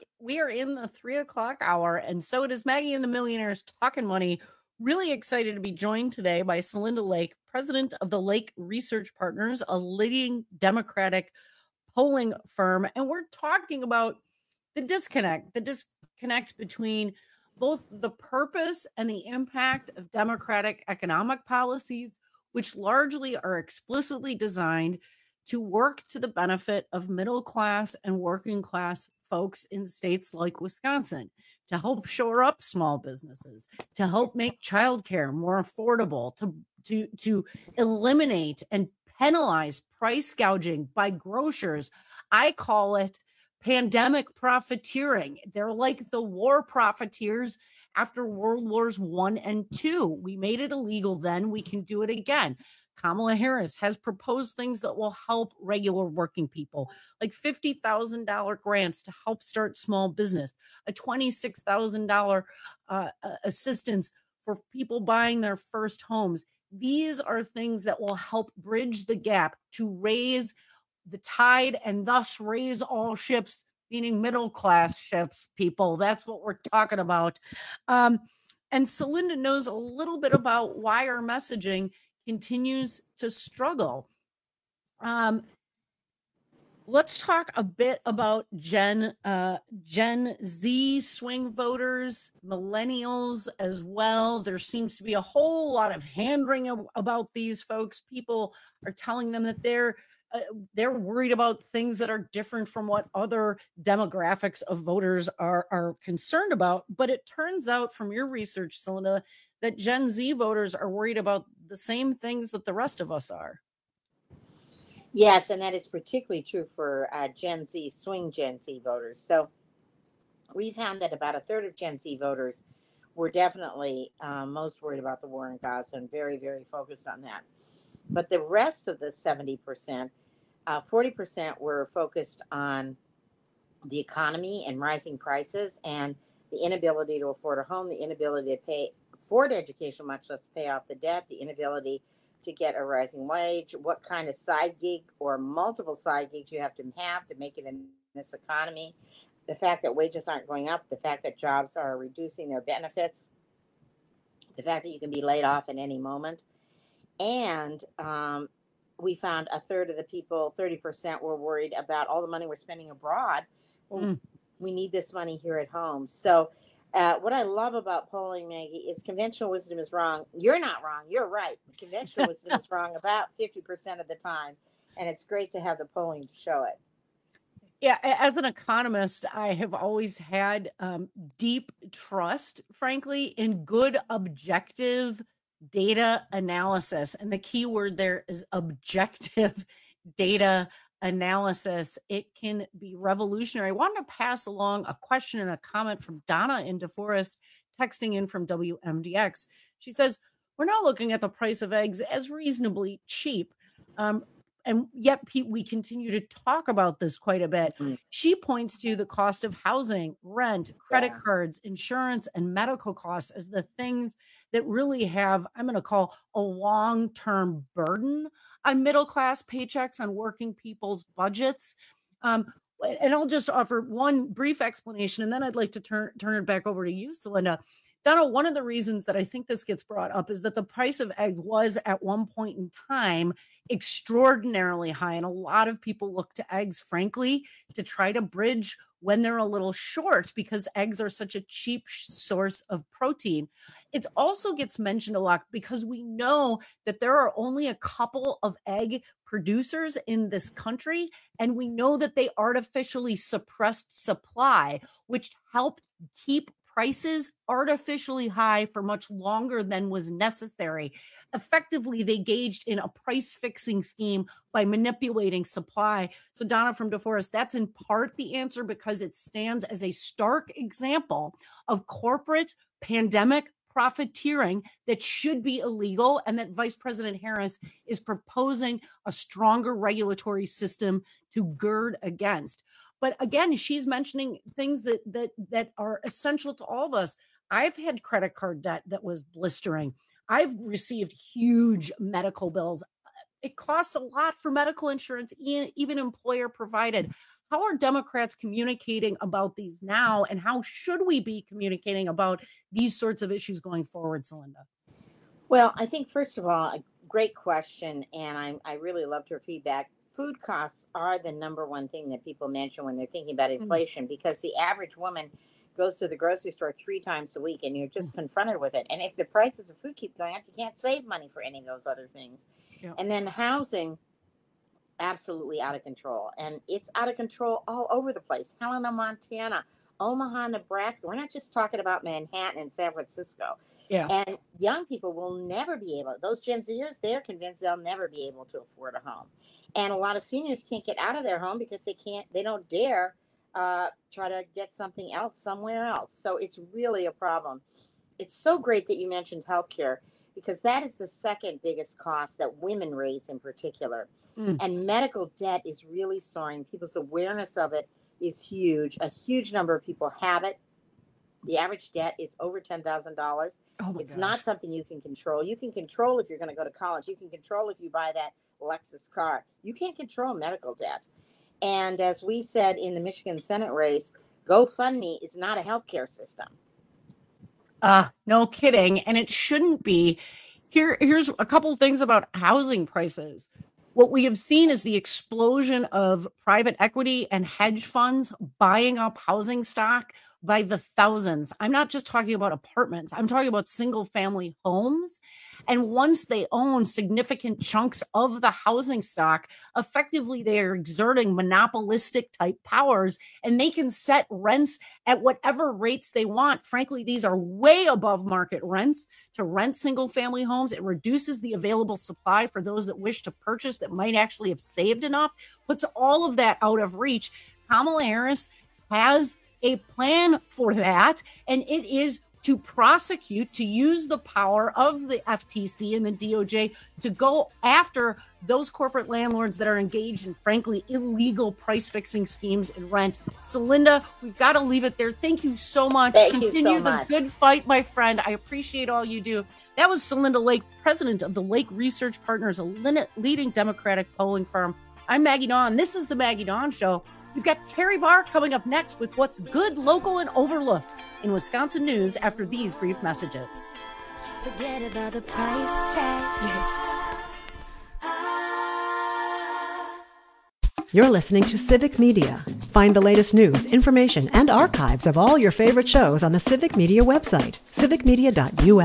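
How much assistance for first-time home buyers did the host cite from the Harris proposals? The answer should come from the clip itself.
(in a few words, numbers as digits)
$26,000.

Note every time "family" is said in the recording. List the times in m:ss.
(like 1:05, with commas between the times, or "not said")
6:34, 6:50.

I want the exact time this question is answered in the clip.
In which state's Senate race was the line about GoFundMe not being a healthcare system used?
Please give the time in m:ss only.
6:12.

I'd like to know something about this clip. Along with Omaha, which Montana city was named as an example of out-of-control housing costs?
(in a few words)
Helena.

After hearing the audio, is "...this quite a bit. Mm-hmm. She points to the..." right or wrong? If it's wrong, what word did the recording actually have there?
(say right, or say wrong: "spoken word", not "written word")
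right.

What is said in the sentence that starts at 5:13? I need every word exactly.
inflation because the average woman goes to the grocery store three times a week and you're mm.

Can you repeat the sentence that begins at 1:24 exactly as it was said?
Um, let's talk a bit about Gen uh, Gen Z swing voters, millennials as well.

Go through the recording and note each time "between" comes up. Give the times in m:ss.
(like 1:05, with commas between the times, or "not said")
0:16.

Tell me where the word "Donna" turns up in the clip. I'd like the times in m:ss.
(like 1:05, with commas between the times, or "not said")
3:16, 3:48, 4:26.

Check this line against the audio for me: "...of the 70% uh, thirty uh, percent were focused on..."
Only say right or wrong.
wrong.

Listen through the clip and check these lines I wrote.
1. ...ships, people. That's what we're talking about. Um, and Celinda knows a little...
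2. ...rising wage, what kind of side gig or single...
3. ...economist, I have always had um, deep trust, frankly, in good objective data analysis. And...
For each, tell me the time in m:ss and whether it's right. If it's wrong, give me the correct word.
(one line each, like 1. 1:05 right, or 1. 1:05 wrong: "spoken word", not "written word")
1. 1:14 right
2. 2:22 wrong: "multiple", not "single"
3. 2:58 right.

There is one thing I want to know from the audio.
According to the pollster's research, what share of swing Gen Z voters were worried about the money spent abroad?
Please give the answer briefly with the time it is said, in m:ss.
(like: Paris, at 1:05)
30%, at 2:40.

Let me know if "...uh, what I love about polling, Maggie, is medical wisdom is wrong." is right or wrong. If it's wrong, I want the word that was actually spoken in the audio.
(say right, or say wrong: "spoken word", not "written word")
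wrong: "conventional", not "medical".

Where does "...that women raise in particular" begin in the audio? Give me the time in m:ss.
5:52.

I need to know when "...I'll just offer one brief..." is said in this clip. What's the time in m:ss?
3:43.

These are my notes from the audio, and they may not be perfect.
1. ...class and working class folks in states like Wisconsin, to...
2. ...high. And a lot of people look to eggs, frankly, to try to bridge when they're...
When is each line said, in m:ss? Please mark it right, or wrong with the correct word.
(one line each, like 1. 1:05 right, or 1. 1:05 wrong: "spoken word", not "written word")
1. 0:27 right
2. 3:54 right.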